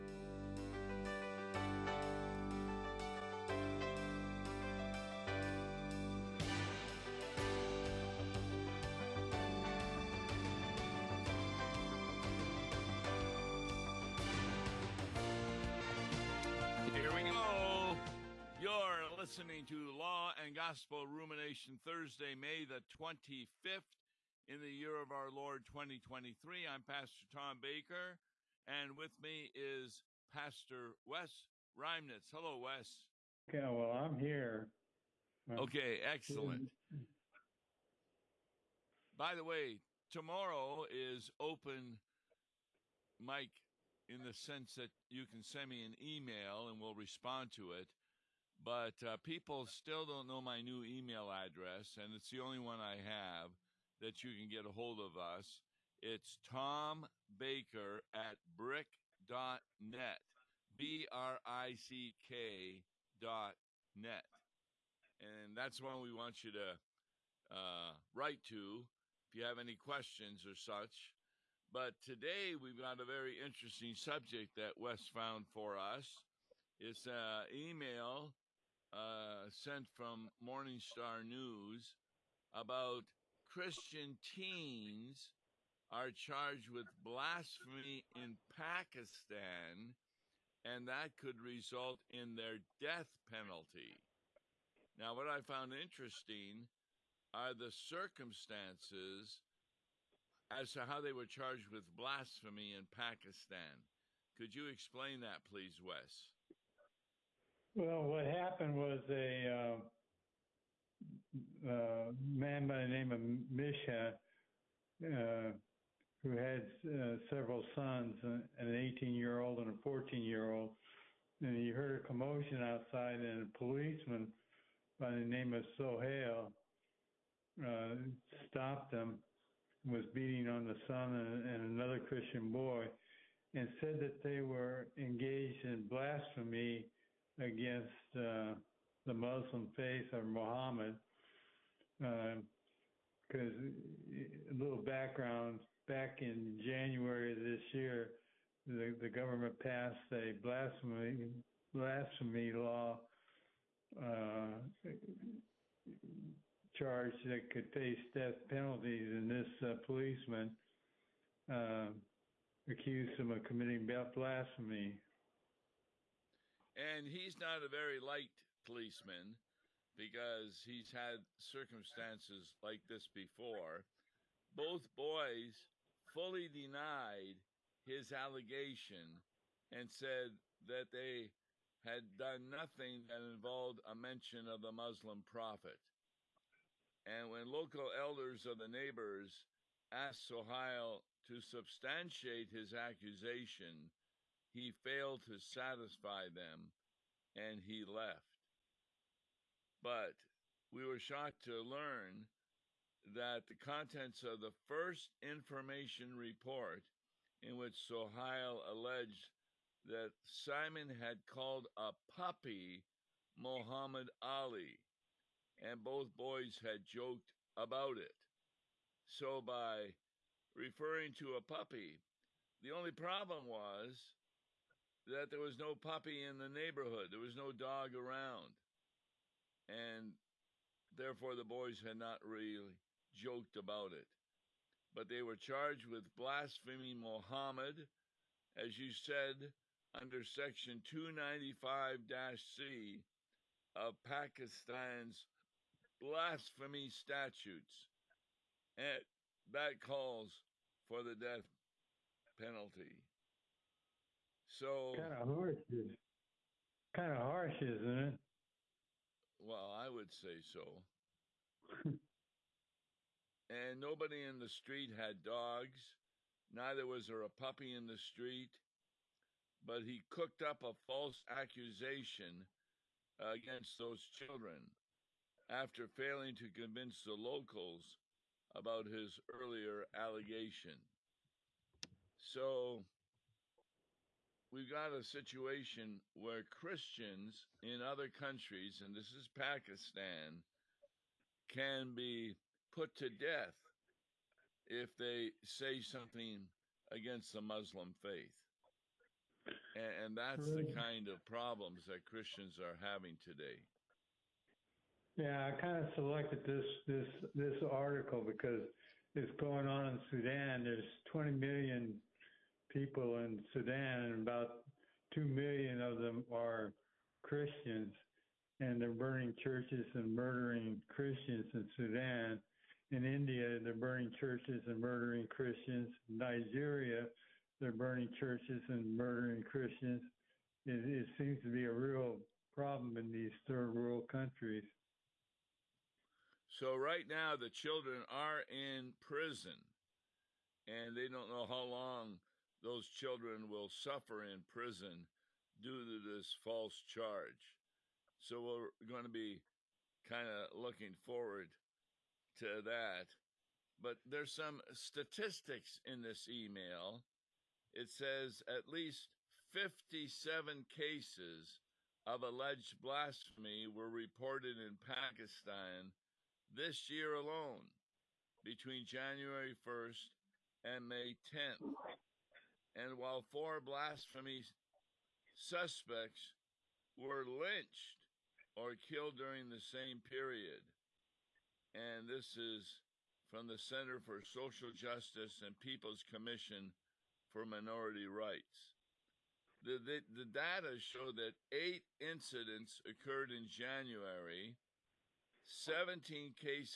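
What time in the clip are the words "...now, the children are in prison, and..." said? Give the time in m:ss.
5:37.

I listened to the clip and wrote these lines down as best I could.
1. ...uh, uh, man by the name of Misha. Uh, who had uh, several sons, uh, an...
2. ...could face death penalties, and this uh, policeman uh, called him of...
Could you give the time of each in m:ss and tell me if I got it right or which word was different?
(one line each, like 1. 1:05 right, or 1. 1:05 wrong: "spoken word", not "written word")
1. 1:51 right
2. 2:37 wrong: "accused", not "called".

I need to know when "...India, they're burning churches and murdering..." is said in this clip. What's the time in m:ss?
5:23.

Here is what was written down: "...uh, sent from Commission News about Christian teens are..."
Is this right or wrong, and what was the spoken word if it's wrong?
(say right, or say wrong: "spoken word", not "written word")
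wrong: "Morningstar", not "Commission".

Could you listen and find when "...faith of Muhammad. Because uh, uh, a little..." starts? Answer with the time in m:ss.
2:19.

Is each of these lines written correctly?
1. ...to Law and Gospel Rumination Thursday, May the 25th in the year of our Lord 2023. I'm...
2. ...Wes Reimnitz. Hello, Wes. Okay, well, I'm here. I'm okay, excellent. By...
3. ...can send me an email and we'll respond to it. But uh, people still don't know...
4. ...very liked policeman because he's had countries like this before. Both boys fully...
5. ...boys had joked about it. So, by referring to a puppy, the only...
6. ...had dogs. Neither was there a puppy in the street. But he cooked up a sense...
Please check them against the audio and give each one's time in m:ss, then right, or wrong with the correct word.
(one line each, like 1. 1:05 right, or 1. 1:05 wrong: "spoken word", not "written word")
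1. 0:19 right
2. 0:31 right
3. 0:45 right
4. 2:47 wrong: "circumstances", not "countries"
5. 3:36 right
6. 4:24 wrong: "false", not "sense".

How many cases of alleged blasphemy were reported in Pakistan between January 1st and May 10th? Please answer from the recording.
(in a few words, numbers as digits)
57.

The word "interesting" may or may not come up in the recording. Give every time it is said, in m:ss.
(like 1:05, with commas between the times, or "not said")
1:13, 1:35.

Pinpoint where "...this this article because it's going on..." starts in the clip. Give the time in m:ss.
5:06.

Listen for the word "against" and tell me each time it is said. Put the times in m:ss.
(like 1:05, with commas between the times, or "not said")
2:17, 4:33, 4:56.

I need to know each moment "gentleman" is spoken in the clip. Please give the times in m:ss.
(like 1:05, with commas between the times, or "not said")
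not said.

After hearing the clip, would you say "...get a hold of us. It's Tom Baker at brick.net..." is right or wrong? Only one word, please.
right.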